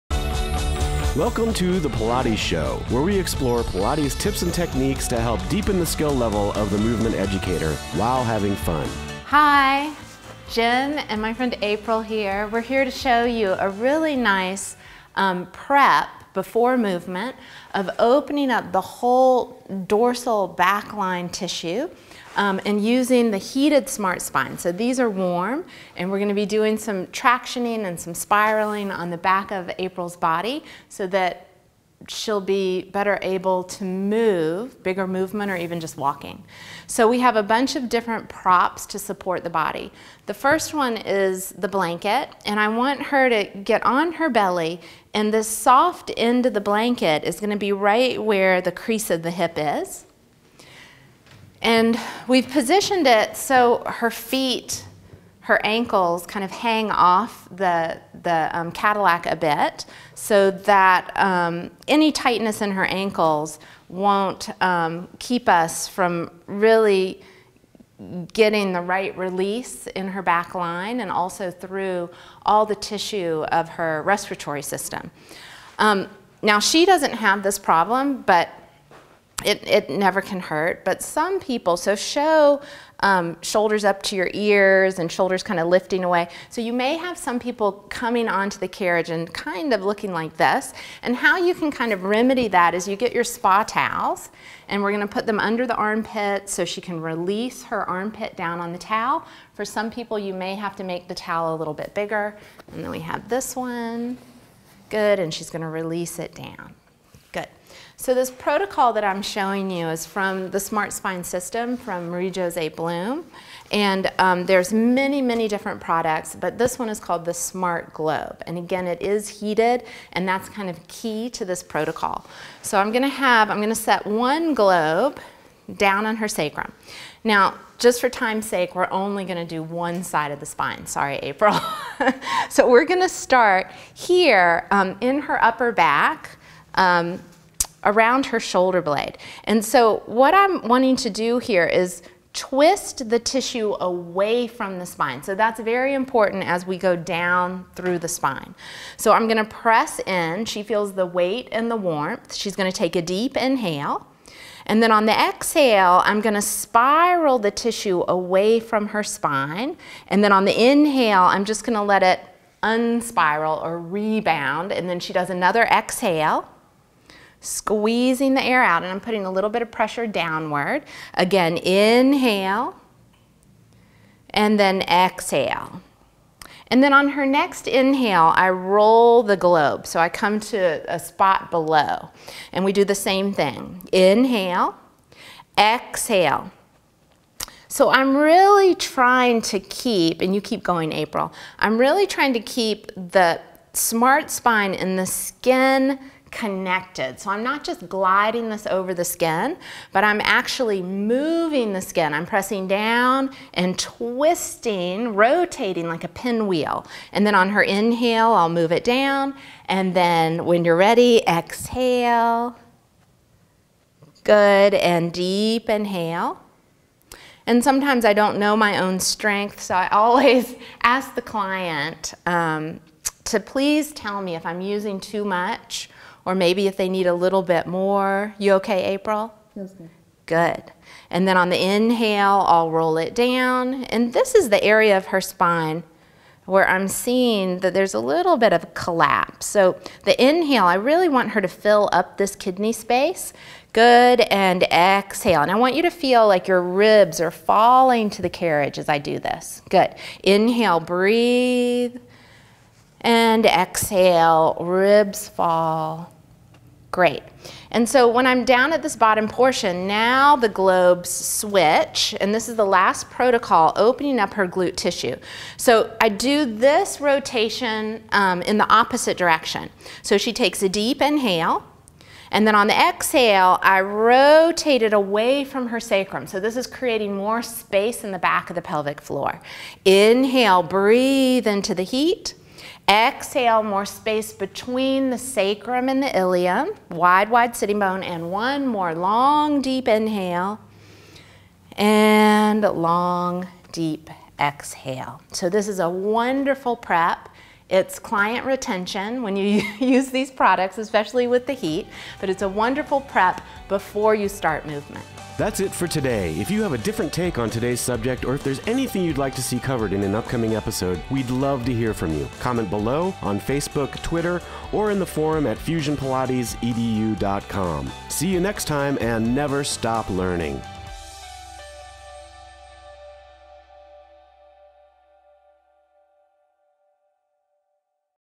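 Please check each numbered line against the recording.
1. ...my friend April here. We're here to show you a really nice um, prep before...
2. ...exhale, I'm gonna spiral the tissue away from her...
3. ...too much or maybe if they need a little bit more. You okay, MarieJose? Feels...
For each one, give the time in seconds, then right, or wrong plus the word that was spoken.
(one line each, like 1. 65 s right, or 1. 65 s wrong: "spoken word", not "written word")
1. 11 s right
2. 155 s right
3. 224 s wrong: "April", not "MarieJose".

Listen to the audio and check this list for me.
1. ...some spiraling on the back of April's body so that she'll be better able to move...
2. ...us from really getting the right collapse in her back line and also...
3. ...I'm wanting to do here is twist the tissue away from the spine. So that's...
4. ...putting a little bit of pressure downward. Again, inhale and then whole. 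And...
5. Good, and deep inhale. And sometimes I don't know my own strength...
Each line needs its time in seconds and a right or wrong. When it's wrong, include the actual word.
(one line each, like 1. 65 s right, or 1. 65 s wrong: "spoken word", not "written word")
1. 27 s right
2. 65 s wrong: "release", not "collapse"
3. 140 s right
4. 169 s wrong: "exhale", not "whole"
5. 214 s right.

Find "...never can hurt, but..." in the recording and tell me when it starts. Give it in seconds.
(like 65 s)
79 s.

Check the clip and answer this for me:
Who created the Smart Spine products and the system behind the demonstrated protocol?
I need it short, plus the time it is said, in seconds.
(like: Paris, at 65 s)
Marie-Jose Blom, at 112 s.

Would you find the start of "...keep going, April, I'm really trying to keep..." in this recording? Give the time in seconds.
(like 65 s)
190 s.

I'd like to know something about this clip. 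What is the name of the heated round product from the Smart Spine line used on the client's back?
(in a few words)
Smart Globe.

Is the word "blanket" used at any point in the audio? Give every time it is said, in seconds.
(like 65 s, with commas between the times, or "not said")
41 s, 46 s.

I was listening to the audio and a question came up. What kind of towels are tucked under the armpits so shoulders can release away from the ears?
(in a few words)
spa towels.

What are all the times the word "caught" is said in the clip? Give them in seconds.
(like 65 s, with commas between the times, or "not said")
not said.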